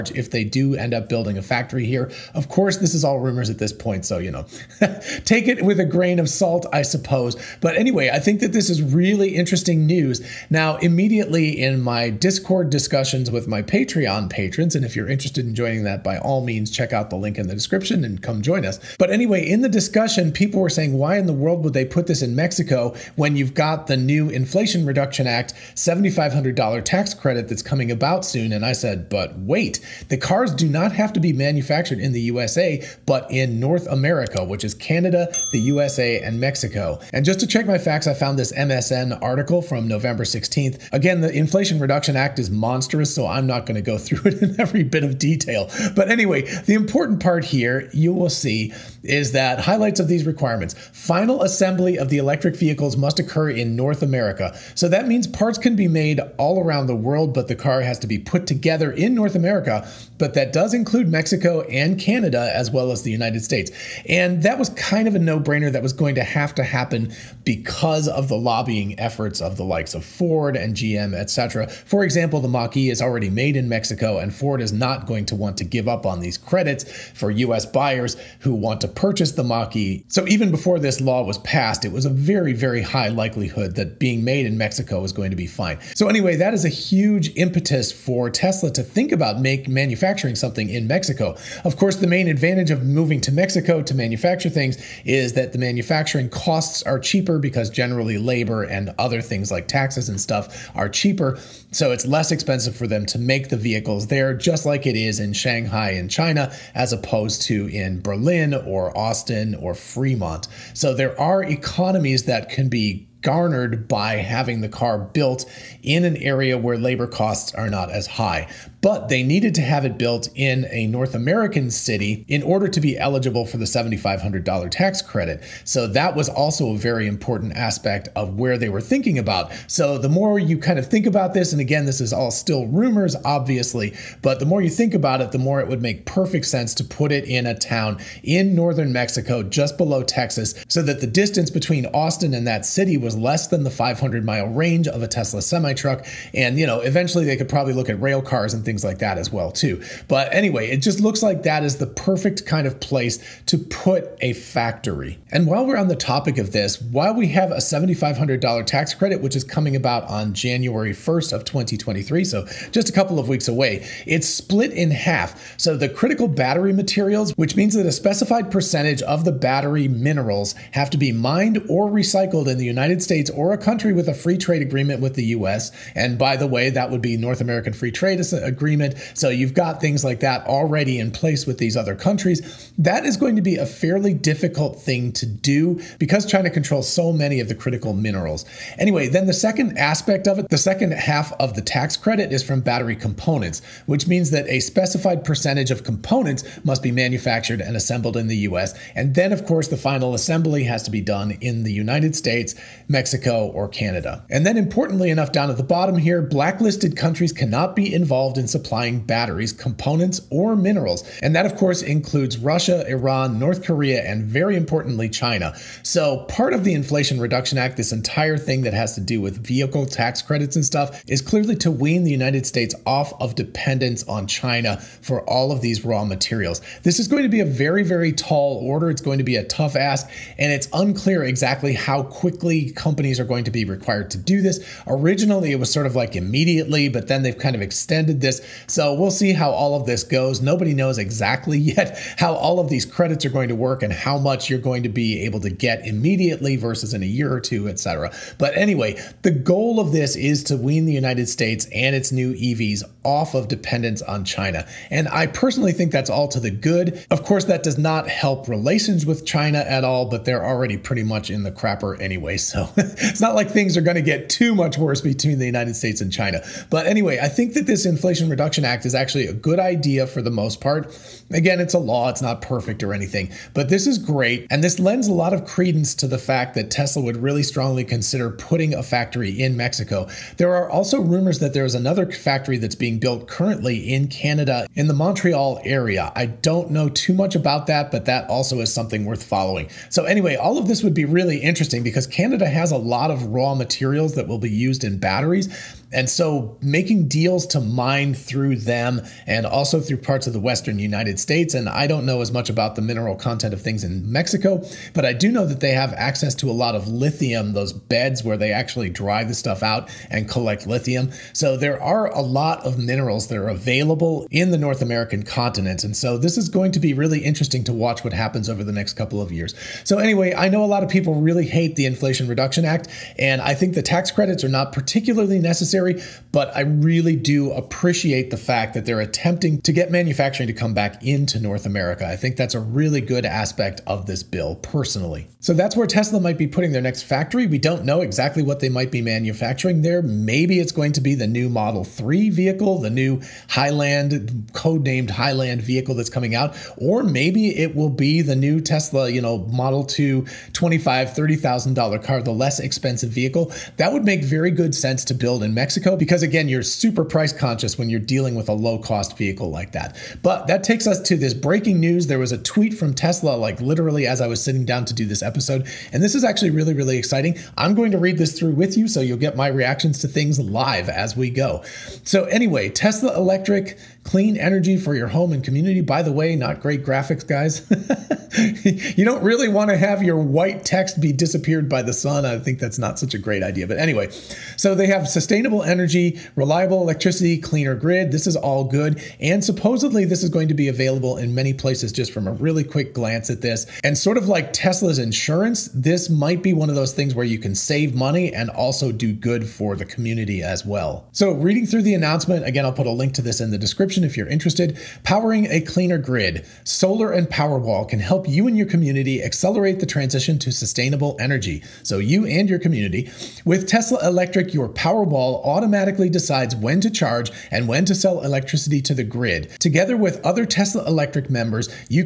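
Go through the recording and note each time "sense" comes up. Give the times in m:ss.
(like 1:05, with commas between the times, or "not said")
2:16, 5:54.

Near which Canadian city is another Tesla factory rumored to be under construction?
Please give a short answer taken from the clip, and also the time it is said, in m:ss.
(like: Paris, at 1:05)
Montreal, at 4:44.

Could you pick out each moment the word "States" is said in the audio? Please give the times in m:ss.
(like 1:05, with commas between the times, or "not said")
1:03, 2:53, 3:22, 3:42, 4:11, 4:25, 5:01.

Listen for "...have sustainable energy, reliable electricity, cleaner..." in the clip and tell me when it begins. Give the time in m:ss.
6:24.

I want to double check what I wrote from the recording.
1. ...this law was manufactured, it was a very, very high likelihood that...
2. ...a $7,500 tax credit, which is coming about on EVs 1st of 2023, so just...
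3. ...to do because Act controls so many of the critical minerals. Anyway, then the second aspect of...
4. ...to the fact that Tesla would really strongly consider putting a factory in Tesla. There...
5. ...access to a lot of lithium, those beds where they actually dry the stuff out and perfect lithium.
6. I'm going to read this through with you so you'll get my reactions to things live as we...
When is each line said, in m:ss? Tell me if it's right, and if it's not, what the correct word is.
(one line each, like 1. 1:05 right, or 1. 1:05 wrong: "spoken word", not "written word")
1. 1:20 wrong: "passed", not "manufactured"
2. 2:37 wrong: "January", not "EVs"
3. 3:05 wrong: "China", not "Act"
4. 4:35 wrong: "Mexico", not "Tesla"
5. 5:05 wrong: "collect", not "perfect"
6. 6:07 right.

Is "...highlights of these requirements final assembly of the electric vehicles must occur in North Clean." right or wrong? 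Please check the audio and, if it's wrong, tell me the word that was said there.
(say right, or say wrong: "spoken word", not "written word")
wrong: "America", not "Clean".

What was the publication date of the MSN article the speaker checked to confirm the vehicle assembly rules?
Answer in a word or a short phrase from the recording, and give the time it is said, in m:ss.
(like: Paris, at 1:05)
November 16th, at 0:39.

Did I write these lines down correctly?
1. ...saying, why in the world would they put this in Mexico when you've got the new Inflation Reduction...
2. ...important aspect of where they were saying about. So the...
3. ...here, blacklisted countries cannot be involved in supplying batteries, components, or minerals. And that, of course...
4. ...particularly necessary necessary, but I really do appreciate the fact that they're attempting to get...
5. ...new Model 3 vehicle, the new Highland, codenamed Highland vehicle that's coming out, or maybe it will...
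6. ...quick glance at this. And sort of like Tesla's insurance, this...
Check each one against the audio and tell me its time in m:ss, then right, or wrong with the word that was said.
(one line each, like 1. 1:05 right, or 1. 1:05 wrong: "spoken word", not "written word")
1. 0:20 right
2. 2:07 wrong: "thinking", not "saying"
3. 3:25 right
4. 5:24 right
5. 5:41 right
6. 6:32 right.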